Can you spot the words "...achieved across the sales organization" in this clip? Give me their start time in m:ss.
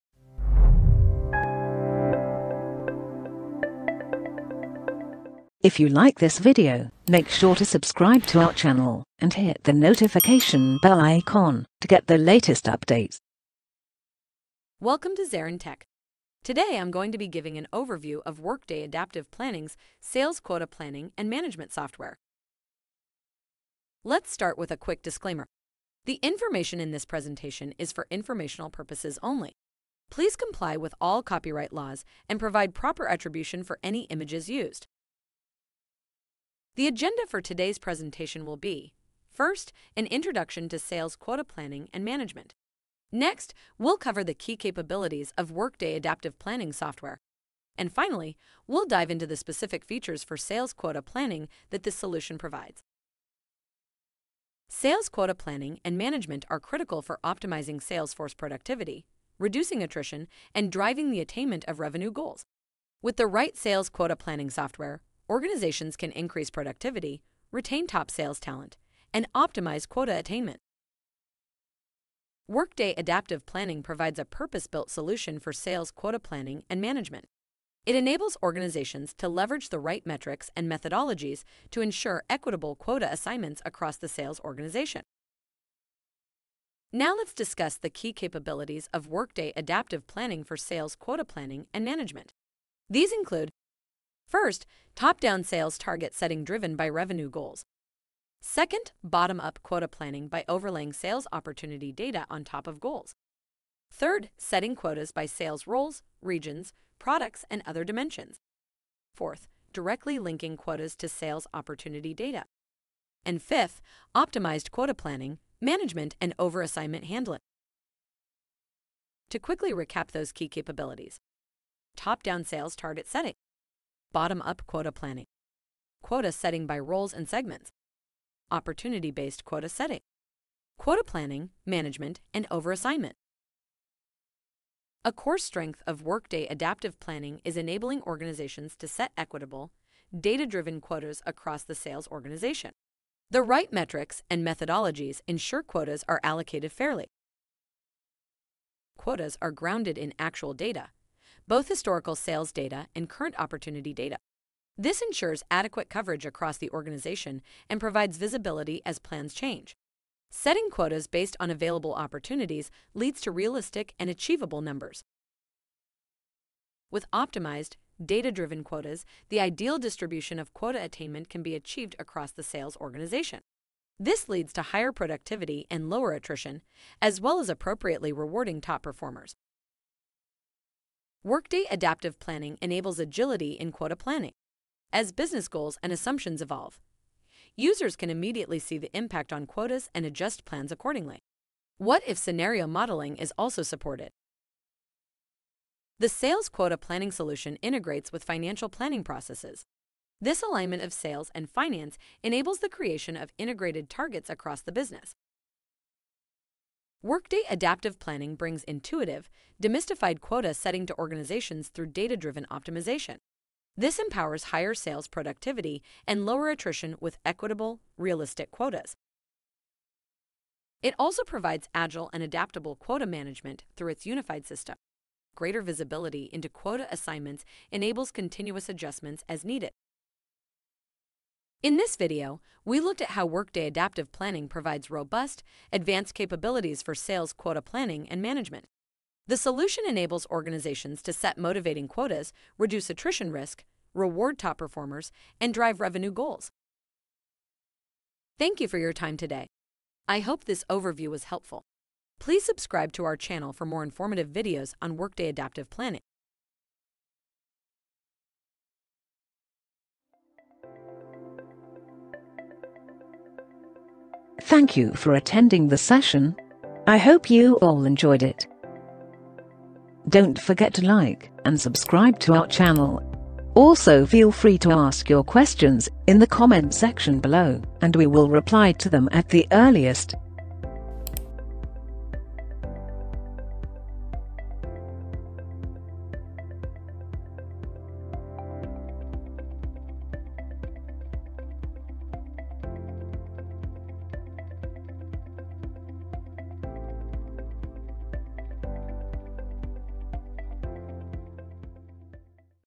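2:51.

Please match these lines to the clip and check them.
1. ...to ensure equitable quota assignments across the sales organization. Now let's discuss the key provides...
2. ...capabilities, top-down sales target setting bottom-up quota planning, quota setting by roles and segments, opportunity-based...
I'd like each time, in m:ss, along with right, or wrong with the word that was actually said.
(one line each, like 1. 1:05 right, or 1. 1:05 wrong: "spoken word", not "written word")
1. 1:21 wrong: "capabilities", not "provides"
2. 2:00 right.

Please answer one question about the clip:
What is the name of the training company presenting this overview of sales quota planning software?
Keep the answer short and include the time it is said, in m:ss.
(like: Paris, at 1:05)
ZaranTech, at 0:15.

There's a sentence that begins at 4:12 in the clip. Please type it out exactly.
Please subscribe to our channel for more informative videos on Workday Adaptive Planning.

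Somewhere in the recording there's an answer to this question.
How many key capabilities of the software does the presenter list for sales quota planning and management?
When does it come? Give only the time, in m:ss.
1:53.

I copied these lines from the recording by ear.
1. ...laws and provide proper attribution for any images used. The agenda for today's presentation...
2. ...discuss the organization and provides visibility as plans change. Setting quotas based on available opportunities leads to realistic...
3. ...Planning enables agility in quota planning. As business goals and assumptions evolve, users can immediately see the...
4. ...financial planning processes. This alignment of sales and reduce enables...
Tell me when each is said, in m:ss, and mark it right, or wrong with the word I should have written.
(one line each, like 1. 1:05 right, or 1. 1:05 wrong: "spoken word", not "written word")
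1. 0:31 right
2. 2:36 wrong: "across", not "discuss"
3. 3:02 right
4. 3:18 wrong: "finance", not "reduce".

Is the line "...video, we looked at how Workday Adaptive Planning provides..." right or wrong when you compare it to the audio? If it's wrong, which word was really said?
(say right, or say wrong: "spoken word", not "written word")
right.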